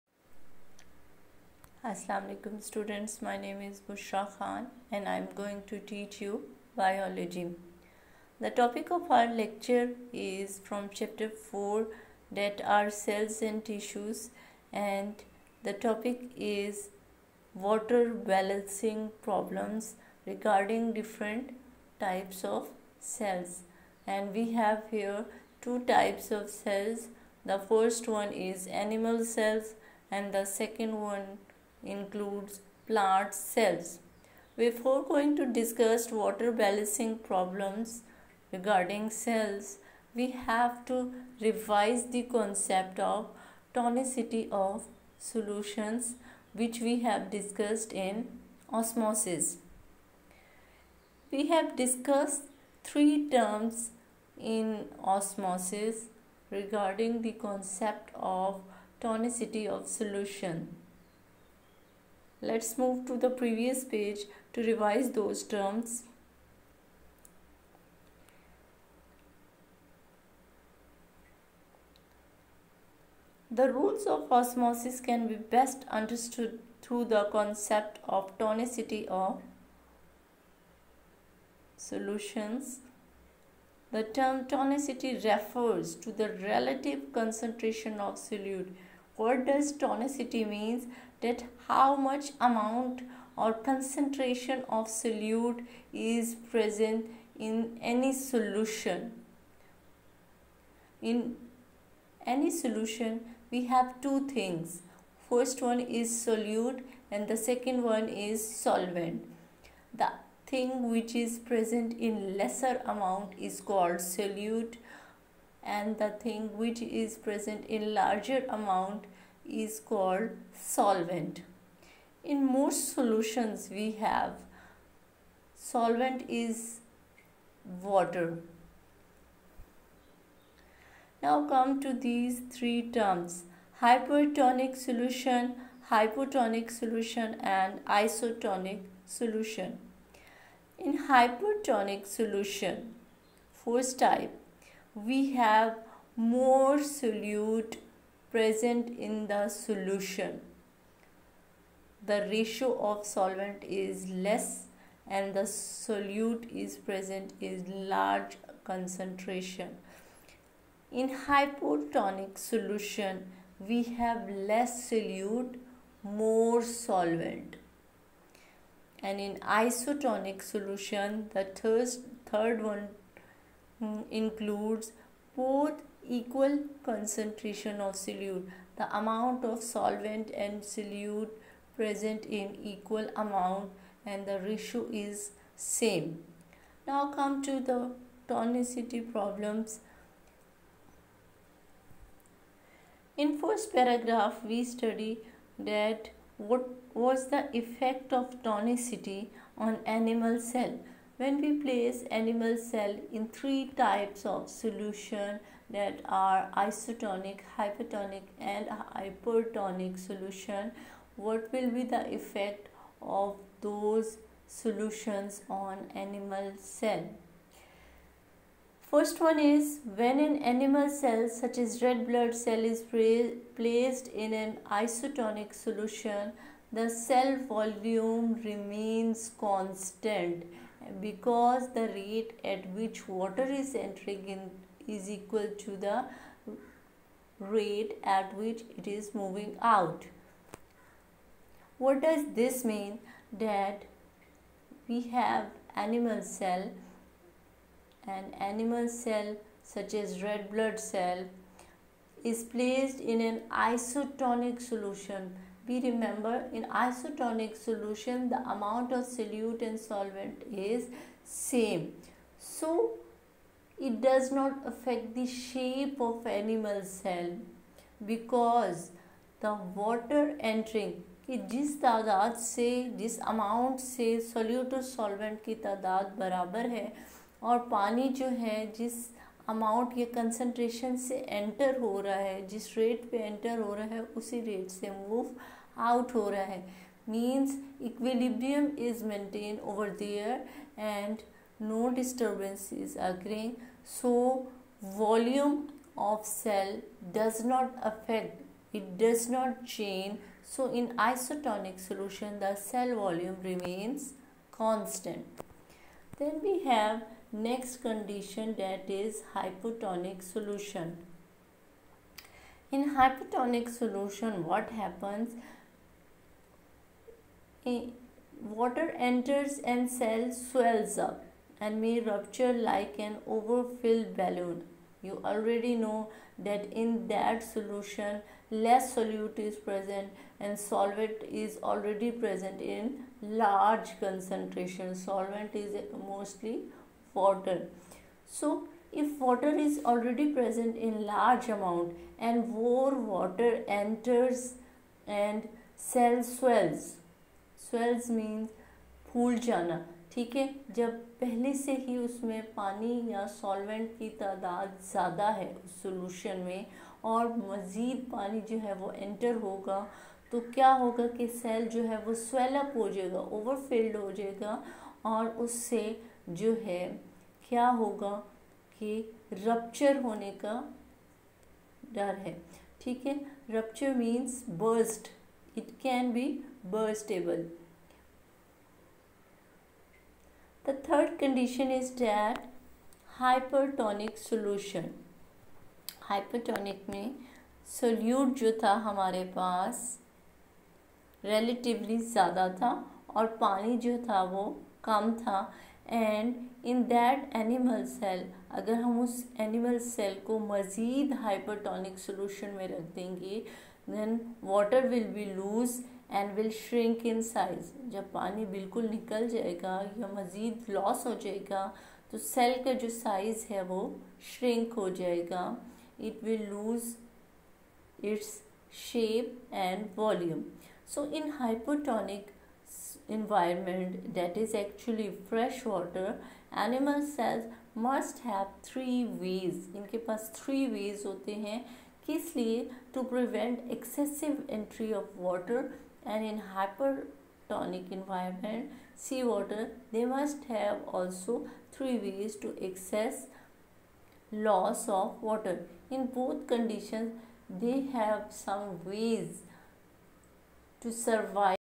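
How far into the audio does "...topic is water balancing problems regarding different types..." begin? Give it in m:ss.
0:15.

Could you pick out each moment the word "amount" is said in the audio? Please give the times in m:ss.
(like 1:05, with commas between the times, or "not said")
1:32, 1:52, 1:58, 2:58, 3:03, 4:18, 5:41.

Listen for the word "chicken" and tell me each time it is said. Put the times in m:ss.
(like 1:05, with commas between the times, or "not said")
not said.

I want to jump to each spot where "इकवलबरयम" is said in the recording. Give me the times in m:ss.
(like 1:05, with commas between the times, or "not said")
4:47.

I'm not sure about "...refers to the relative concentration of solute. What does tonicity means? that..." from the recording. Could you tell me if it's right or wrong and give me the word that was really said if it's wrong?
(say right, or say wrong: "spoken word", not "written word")
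right.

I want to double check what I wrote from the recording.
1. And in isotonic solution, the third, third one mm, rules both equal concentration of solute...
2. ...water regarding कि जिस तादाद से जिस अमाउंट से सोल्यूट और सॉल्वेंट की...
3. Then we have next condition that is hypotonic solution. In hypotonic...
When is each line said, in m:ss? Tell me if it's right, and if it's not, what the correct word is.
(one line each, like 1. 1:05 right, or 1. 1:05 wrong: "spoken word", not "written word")
1. 2:49 wrong: "includes", not "rules"
2. 4:29 wrong: "entering", not "regarding"
3. 5:06 right.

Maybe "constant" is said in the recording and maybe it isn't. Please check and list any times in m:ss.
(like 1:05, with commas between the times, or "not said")
3:49, 5:04.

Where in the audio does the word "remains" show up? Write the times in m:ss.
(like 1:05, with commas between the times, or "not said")
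3:48, 5:03.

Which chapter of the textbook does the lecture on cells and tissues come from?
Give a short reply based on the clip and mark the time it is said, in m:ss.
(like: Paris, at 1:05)
4, at 0:10.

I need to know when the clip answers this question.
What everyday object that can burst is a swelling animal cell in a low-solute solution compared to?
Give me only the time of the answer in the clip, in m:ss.
5:23.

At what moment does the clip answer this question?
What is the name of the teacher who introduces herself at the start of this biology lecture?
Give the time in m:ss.
0:03.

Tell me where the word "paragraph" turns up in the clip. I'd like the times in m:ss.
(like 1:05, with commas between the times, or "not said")
3:13.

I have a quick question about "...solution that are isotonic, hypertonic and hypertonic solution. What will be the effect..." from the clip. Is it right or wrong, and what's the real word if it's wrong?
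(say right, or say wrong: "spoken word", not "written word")
right.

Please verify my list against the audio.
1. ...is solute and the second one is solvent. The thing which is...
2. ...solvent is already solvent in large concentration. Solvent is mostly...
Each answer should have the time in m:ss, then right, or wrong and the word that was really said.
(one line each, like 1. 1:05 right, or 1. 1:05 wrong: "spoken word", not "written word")
1. 1:45 right
2. 5:30 wrong: "present", not "solvent".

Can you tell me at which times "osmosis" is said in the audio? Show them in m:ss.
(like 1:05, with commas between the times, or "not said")
0:48, 0:55, 1:14.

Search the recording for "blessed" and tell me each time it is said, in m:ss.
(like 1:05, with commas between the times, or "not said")
not said.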